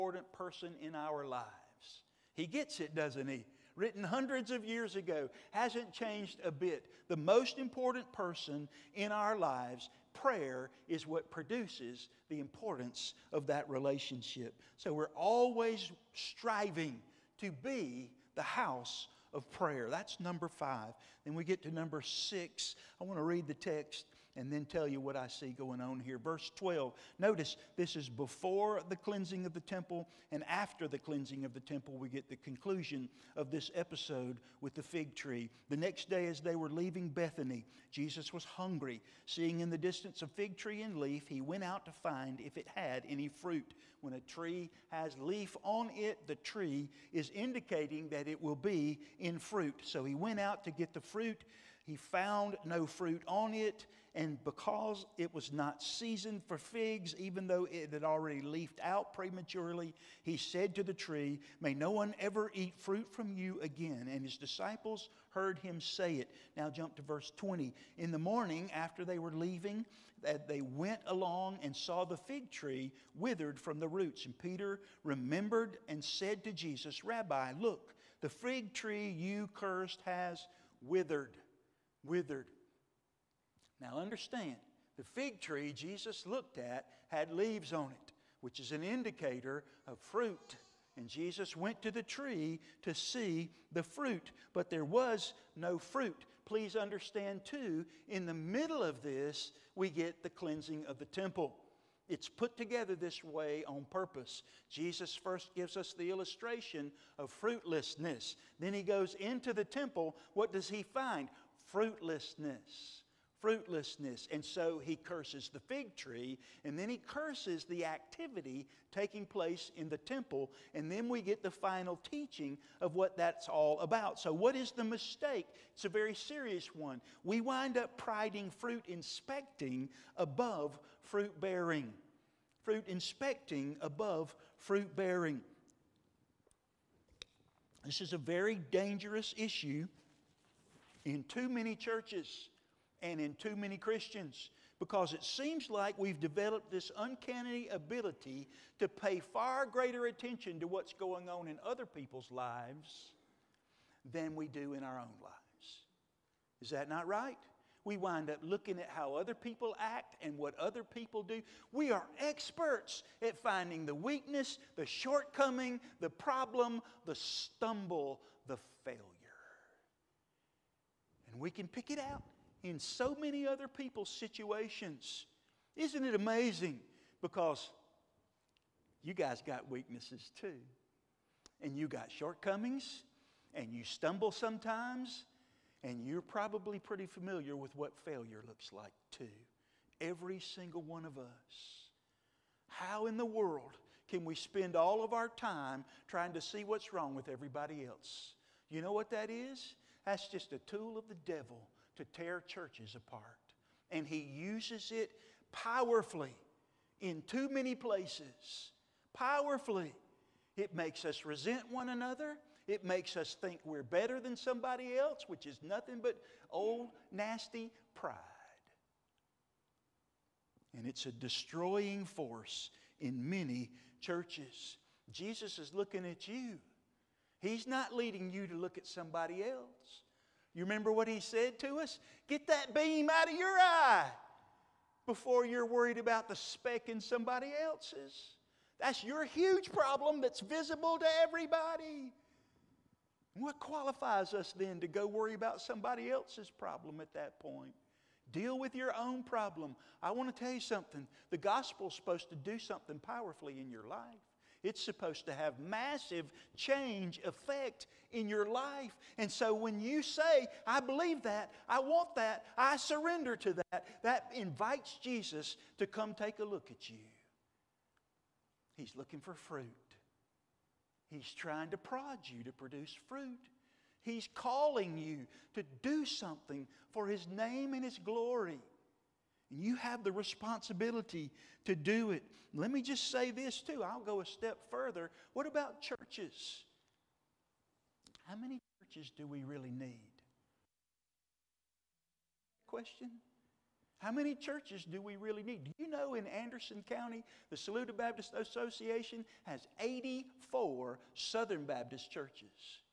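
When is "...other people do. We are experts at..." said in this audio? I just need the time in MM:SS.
02:40.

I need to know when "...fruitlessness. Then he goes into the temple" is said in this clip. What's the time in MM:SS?
01:47.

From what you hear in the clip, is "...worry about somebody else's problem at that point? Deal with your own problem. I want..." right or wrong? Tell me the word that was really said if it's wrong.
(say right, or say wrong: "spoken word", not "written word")
right.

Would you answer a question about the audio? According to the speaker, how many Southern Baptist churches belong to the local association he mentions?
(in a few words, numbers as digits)
84.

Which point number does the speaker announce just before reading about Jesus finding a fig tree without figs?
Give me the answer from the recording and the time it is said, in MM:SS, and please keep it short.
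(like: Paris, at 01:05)
6, at 00:21.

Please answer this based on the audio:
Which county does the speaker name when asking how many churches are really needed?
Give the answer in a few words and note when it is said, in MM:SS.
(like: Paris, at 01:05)
Anderson County, at 04:56.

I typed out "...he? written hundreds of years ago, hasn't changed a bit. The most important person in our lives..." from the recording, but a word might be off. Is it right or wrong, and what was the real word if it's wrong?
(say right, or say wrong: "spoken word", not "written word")
right.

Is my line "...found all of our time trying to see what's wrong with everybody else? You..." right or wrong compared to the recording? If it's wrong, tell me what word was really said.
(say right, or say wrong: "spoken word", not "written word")
wrong: "spend", not "found".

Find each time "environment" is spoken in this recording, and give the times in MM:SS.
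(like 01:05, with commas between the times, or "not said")
not said.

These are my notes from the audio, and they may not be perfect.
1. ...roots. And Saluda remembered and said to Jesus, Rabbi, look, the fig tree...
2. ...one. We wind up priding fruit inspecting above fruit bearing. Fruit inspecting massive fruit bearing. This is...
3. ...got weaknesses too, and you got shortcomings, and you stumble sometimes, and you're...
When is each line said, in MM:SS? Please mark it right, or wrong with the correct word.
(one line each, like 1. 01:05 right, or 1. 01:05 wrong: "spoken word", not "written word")
1. 01:13 wrong: "Peter", not "Saluda"
2. 02:06 wrong: "above", not "massive"
3. 02:59 right.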